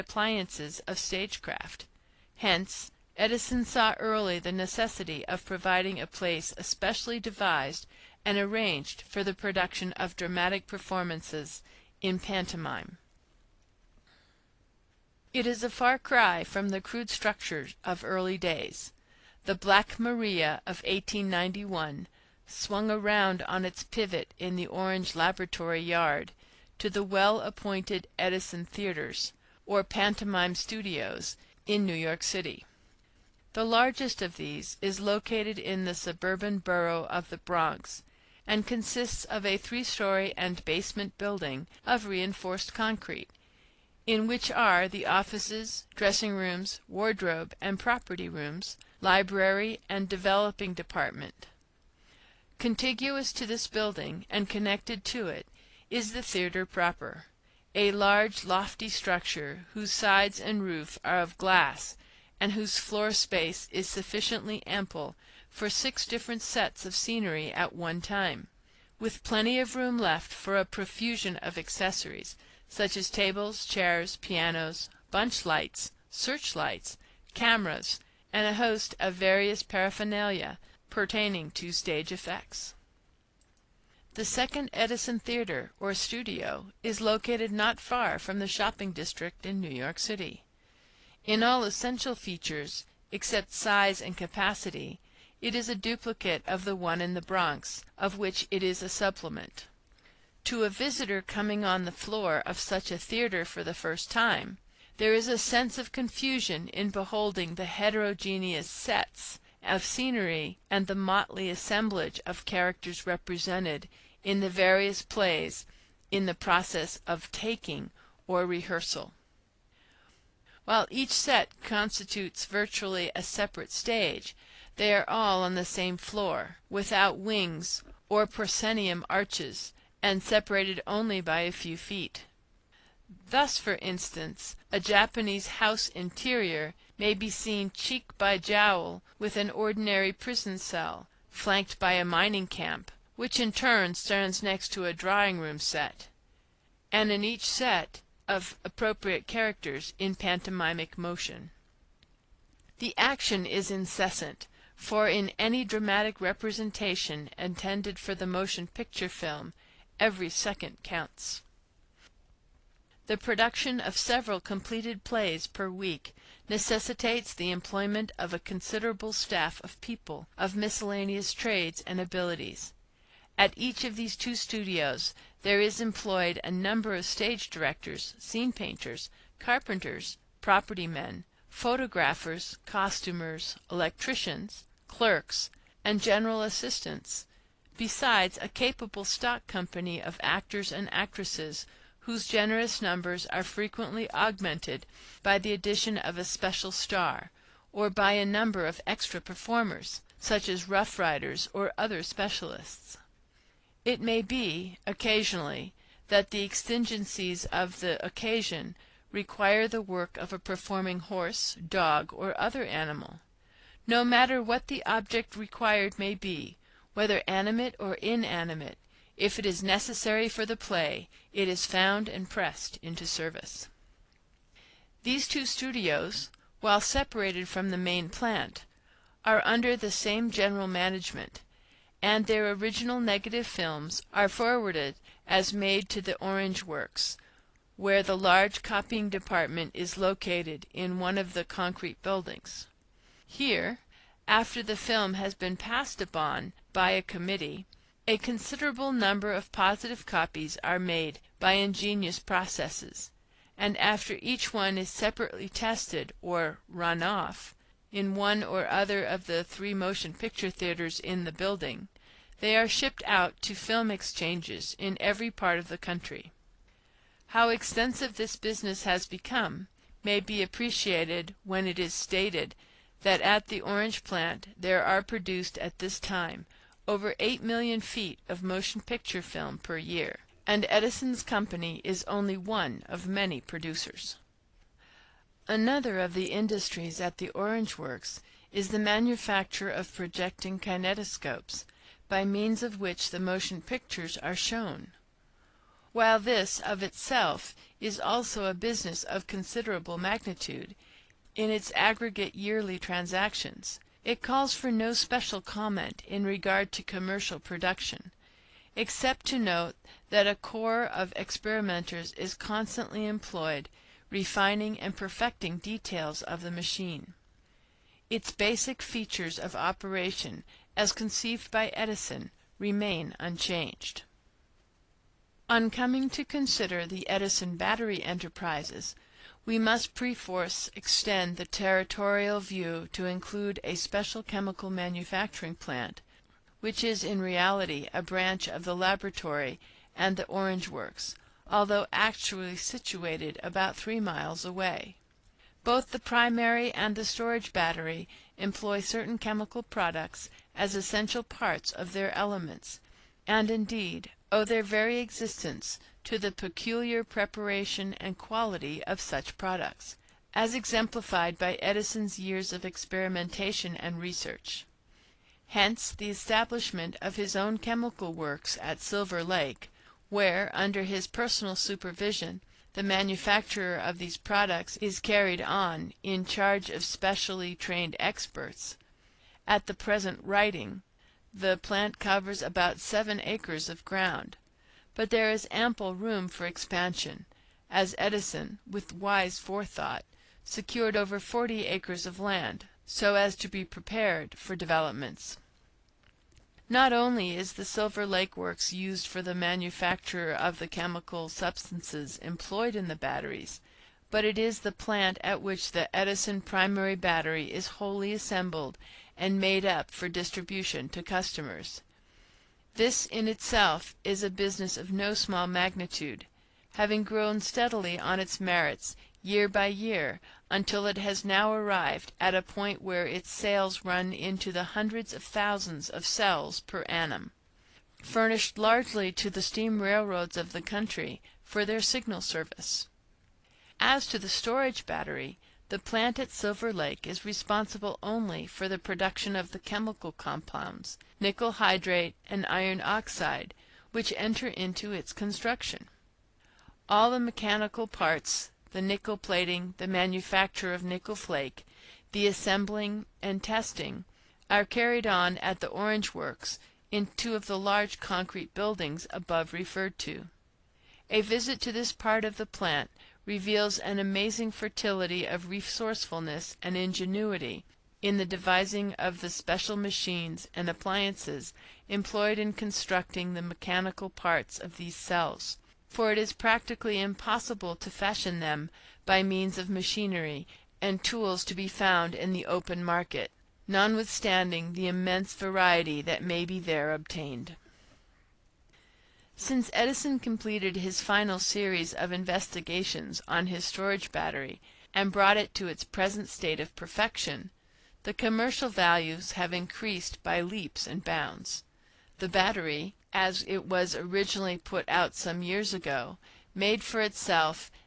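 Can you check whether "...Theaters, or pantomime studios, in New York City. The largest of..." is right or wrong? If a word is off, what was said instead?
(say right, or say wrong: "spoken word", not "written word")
right.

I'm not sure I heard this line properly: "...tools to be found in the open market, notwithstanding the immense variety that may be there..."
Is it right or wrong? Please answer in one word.
right.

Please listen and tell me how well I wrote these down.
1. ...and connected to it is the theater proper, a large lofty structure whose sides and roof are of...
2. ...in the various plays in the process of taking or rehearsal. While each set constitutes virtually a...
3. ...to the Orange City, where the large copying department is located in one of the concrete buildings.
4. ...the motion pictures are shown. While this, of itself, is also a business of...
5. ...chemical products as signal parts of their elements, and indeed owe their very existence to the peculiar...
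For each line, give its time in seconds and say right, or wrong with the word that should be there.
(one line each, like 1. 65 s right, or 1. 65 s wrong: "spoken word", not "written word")
1. 54 s right
2. 114 s right
3. 235 s wrong: "Works", not "City"
4. 293 s right
5. 349 s wrong: "essential", not "signal".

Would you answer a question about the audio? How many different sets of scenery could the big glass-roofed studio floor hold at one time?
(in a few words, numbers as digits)
6.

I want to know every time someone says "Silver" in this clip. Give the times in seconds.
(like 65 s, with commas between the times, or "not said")
368 s, 397 s, 436 s.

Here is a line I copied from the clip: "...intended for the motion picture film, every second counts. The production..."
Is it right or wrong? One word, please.
right.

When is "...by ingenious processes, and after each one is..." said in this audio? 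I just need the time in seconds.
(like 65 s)
251 s.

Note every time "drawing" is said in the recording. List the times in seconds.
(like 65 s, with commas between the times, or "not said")
144 s.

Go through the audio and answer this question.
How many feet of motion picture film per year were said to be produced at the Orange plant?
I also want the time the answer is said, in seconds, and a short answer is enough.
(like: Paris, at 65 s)
over 8 million feet, at 276 s.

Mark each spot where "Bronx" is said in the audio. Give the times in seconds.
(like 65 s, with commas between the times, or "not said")
37 s, 97 s.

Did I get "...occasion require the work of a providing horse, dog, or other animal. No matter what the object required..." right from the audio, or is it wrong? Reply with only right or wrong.
wrong.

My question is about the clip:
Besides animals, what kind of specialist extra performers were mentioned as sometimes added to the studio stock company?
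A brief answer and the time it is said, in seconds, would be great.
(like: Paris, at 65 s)
Rough Riders, at 200 s.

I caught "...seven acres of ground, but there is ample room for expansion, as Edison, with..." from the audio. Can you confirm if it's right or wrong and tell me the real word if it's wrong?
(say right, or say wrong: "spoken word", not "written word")
right.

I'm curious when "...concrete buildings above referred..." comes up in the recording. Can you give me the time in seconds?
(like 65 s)
457 s.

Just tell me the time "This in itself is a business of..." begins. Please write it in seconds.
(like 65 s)
412 s.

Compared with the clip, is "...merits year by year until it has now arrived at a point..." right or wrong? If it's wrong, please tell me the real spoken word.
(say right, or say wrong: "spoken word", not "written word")
right.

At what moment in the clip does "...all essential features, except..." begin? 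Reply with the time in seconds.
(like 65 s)
91 s.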